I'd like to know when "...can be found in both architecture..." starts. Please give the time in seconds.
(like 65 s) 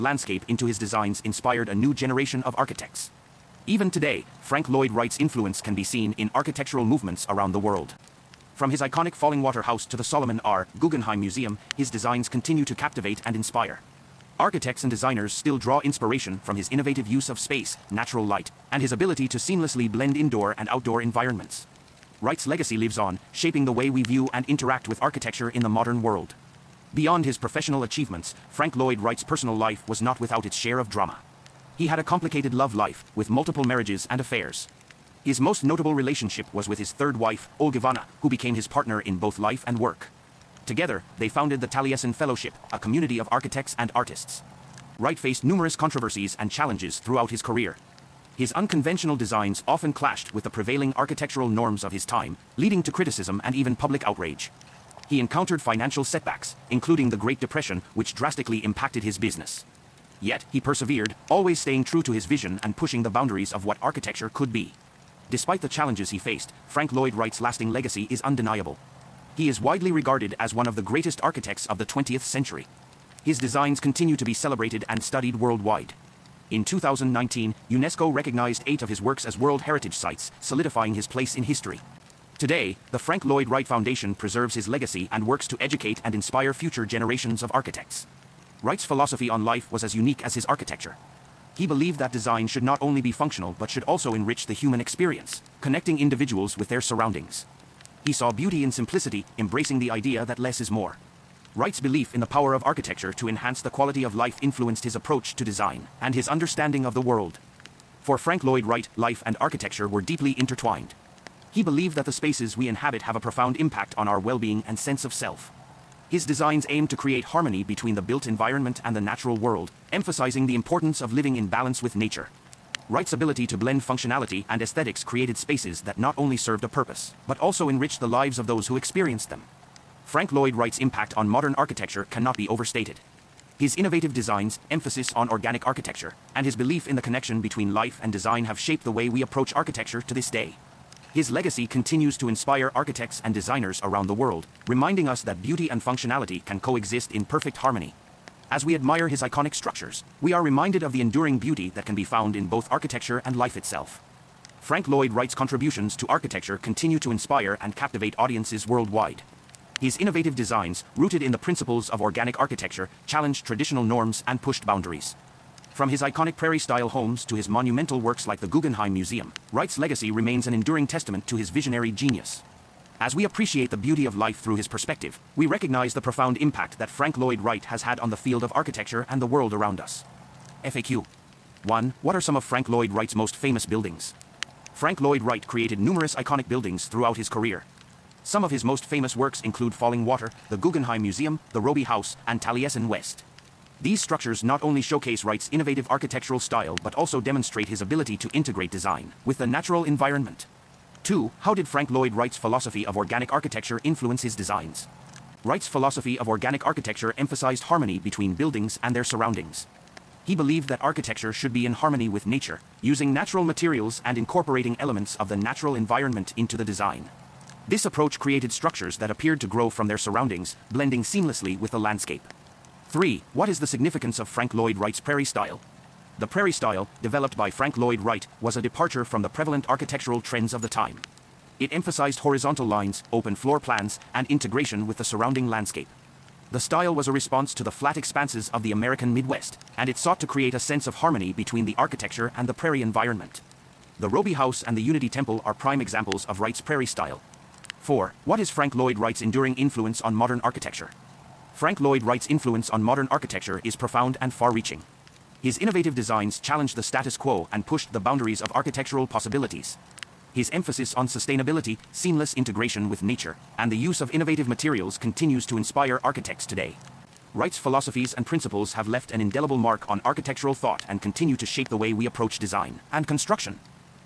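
151 s.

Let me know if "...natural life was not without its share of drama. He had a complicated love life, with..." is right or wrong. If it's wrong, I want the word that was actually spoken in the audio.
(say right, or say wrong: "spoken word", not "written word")
wrong: "personal", not "natural".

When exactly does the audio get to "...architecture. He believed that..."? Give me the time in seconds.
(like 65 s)
90 s.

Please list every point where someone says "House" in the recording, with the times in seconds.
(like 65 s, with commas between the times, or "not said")
9 s, 191 s, 244 s.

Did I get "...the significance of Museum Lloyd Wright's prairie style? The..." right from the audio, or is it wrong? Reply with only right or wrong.
wrong.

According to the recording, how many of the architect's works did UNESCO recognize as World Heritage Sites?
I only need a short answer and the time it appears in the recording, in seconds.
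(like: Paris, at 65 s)
8, at 78 s.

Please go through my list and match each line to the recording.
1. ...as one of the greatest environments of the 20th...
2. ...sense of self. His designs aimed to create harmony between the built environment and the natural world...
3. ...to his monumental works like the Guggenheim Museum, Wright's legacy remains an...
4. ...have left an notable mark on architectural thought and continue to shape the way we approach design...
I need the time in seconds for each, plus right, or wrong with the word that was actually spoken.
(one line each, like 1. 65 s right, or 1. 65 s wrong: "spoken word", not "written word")
1. 70 s wrong: "architects", not "environments"
2. 114 s right
3. 167 s right
4. 268 s wrong: "indelible", not "notable".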